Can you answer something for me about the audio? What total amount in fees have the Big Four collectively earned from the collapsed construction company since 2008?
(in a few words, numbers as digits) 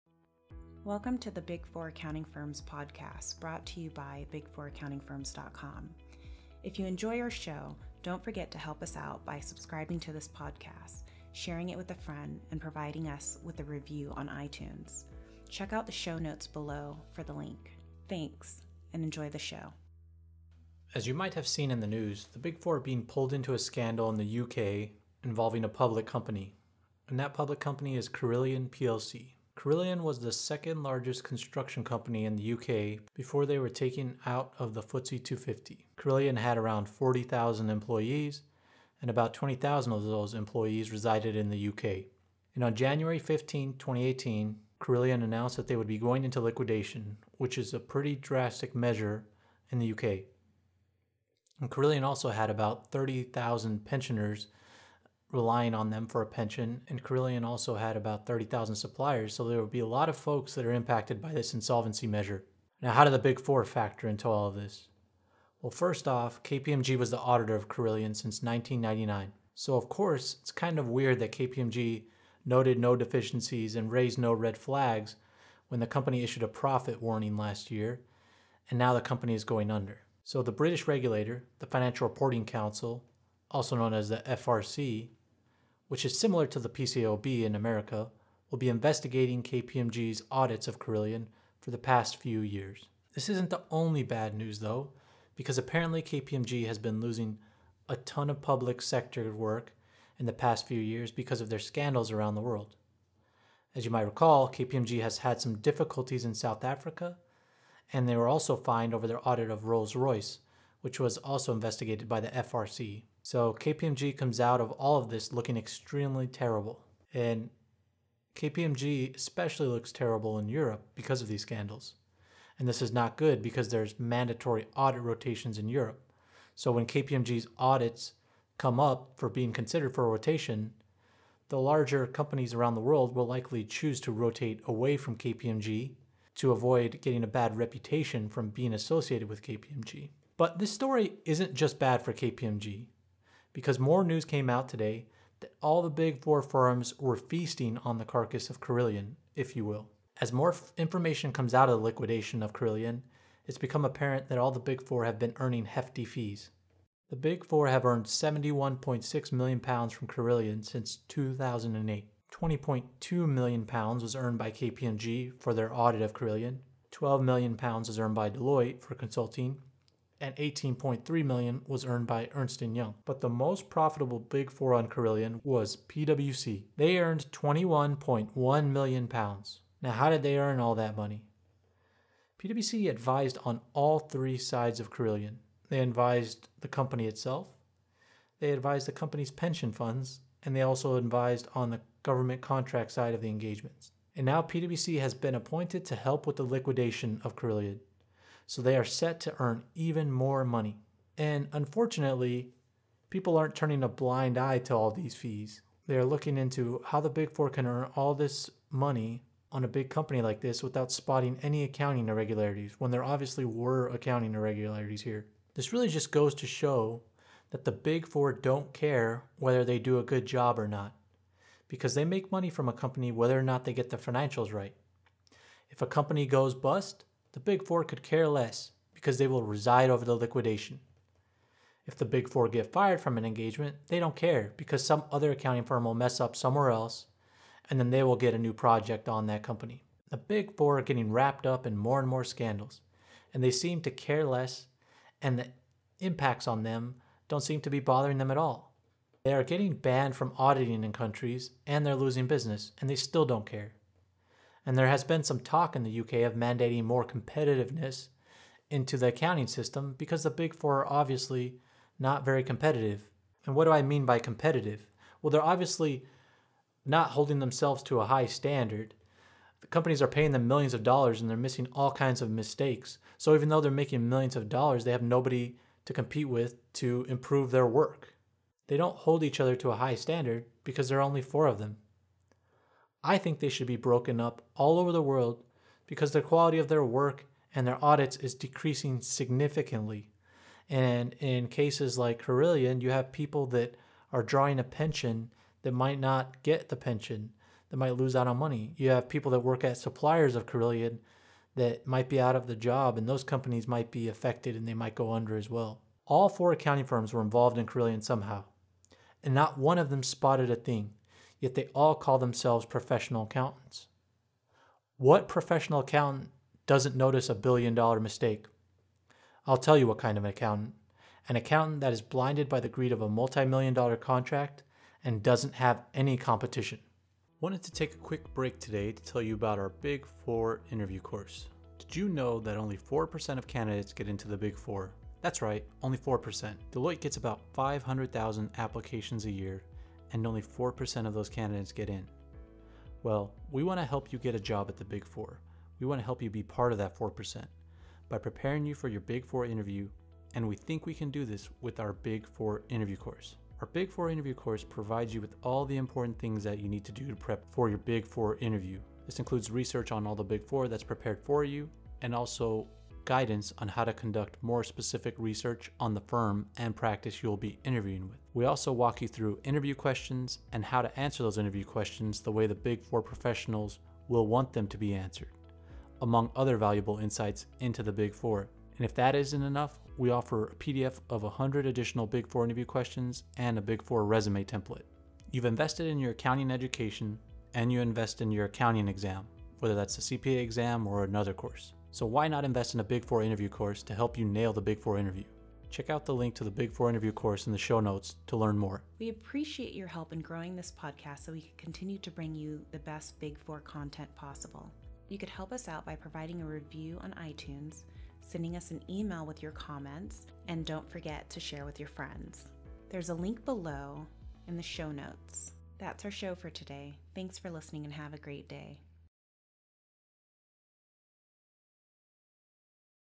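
£71.6 million.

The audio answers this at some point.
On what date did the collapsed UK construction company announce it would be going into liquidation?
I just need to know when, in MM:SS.
00:42.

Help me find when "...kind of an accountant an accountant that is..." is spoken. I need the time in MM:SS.
05:19.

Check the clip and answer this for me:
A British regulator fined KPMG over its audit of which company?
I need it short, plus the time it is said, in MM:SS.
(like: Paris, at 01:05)
Rolls Royce, at 01:49.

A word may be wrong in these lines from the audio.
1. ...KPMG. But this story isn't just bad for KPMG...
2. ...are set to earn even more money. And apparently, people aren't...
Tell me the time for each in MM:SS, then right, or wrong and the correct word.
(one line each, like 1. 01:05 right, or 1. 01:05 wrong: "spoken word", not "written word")
1. 02:19 right
2. 03:18 wrong: "unfortunately", not "apparently".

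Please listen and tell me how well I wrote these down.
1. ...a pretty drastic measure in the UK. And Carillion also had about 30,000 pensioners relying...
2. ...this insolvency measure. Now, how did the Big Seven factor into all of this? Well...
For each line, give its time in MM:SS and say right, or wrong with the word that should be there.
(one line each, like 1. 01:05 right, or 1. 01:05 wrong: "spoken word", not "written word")
1. 00:47 right
2. 01:01 wrong: "Four", not "Seven".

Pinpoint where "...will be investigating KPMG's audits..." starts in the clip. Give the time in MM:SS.
01:28.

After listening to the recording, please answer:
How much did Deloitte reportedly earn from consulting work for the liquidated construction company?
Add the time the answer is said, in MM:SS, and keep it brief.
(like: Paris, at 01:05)
£12 million, at 02:46.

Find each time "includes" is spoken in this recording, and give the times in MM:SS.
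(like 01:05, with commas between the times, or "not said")
05:59.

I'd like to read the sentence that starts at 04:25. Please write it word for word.
Well, they're obviously not holding themselves to a high standard.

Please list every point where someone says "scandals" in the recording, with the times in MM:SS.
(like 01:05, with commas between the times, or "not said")
00:23, 01:41, 02:01, 04:02.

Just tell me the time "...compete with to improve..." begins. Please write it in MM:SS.
04:35.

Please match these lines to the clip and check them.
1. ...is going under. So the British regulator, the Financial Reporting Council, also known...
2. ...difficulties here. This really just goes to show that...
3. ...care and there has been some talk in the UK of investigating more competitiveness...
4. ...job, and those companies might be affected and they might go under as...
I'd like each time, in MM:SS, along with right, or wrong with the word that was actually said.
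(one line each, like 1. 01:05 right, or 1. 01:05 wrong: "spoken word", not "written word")
1. 01:19 right
2. 03:34 wrong: "irregularities", not "difficulties"
3. 04:13 wrong: "mandating", not "investigating"
4. 05:02 right.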